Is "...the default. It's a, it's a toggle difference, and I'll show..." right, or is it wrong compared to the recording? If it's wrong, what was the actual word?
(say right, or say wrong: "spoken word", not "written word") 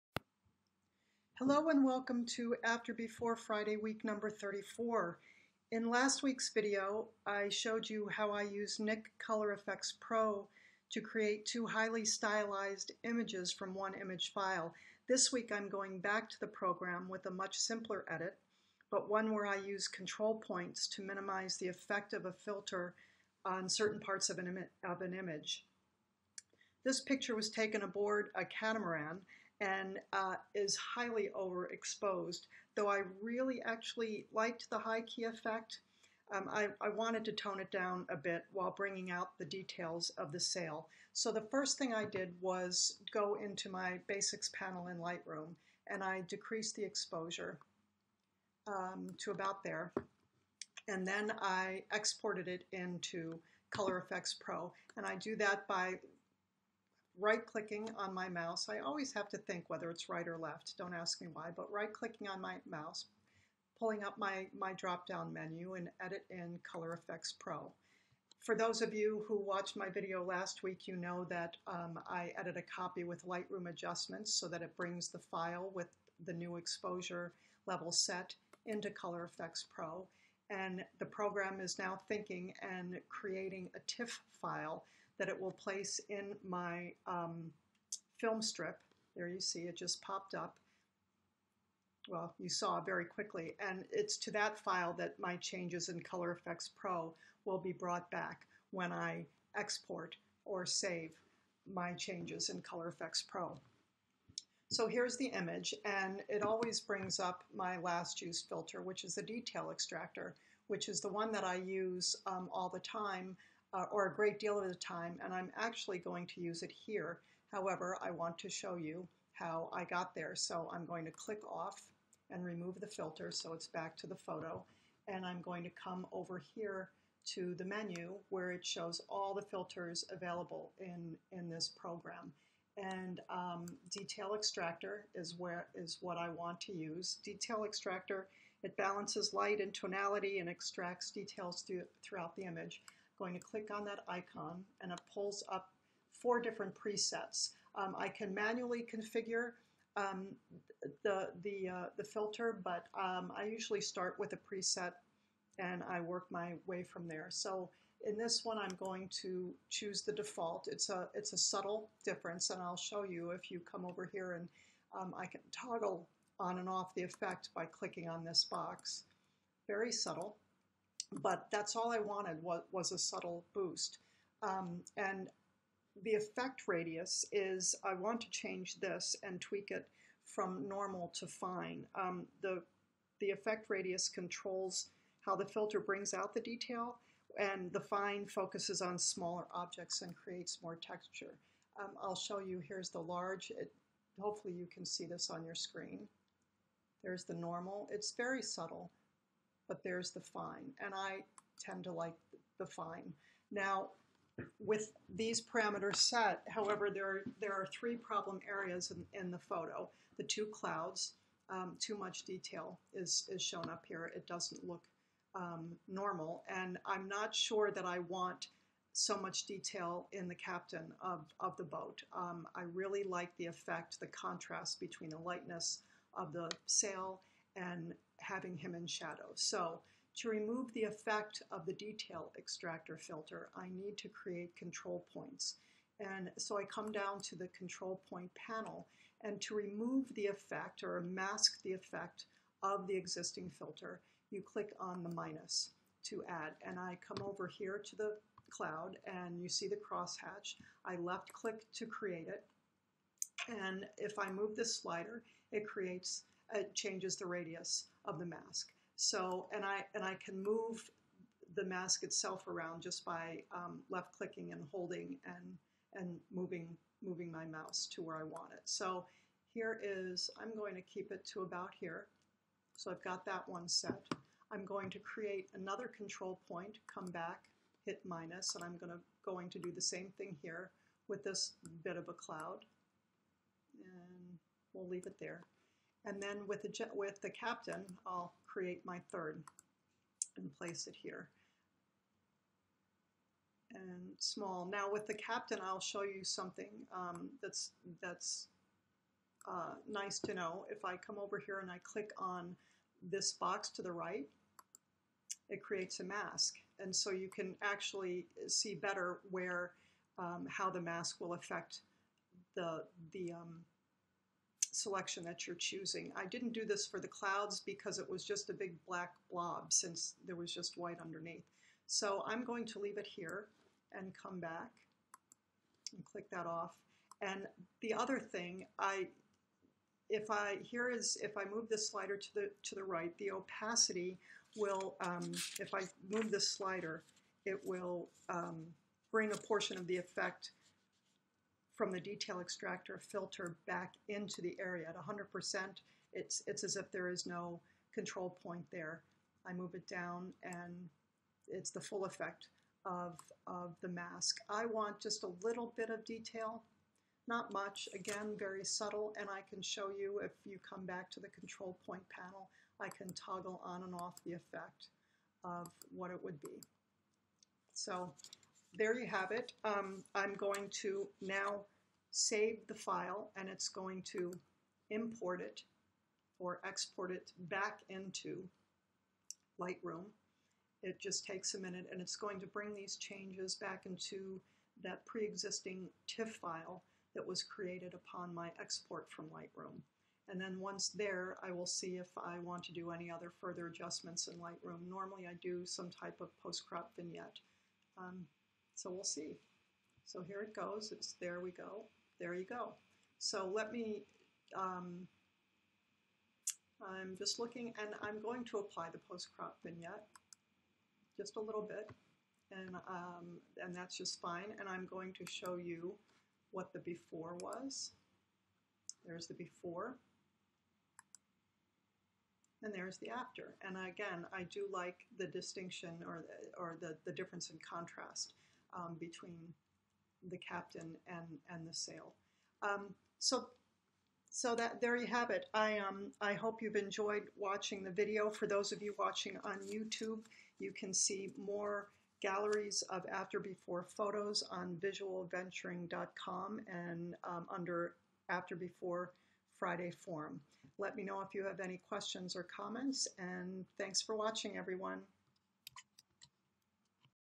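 wrong: "subtle", not "toggle".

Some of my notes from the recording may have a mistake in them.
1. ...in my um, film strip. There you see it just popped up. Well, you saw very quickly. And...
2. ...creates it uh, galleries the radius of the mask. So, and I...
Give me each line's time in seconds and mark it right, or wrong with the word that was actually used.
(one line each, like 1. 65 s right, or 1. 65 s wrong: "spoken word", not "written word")
1. 86 s right
2. 255 s wrong: "changes", not "galleries".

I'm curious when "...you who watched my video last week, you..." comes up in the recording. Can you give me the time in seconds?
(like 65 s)
68 s.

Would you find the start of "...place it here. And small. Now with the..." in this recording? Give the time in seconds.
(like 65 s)
290 s.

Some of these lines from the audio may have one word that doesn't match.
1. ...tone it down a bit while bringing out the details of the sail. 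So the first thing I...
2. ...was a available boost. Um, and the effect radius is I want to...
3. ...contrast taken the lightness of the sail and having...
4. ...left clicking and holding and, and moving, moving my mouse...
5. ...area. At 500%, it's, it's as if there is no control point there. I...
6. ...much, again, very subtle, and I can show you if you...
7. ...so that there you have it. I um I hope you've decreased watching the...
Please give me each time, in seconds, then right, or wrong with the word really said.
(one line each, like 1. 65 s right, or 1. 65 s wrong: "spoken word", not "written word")
1. 37 s right
2. 172 s wrong: "subtle", not "available"
3. 224 s wrong: "between", not "taken"
4. 263 s right
5. 344 s wrong: "100", not "500"
6. 357 s right
7. 434 s wrong: "enjoyed", not "decreased".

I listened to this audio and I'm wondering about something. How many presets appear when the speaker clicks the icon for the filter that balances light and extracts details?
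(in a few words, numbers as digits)
4.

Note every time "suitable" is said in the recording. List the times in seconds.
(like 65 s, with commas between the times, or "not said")
not said.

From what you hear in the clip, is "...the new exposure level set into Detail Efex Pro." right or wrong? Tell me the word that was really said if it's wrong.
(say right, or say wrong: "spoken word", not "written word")
wrong: "Color", not "Detail".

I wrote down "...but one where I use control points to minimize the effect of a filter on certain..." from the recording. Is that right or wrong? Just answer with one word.
right.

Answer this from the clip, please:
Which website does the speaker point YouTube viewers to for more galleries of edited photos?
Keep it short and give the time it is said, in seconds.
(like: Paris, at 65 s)
visualventuring.com, at 444 s.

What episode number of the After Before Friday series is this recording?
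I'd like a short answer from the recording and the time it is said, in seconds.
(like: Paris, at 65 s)
34, at 4 s.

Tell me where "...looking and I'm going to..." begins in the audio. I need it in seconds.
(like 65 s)
407 s.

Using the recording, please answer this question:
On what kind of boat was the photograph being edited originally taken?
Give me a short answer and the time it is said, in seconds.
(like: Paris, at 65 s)
catamaran, at 28 s.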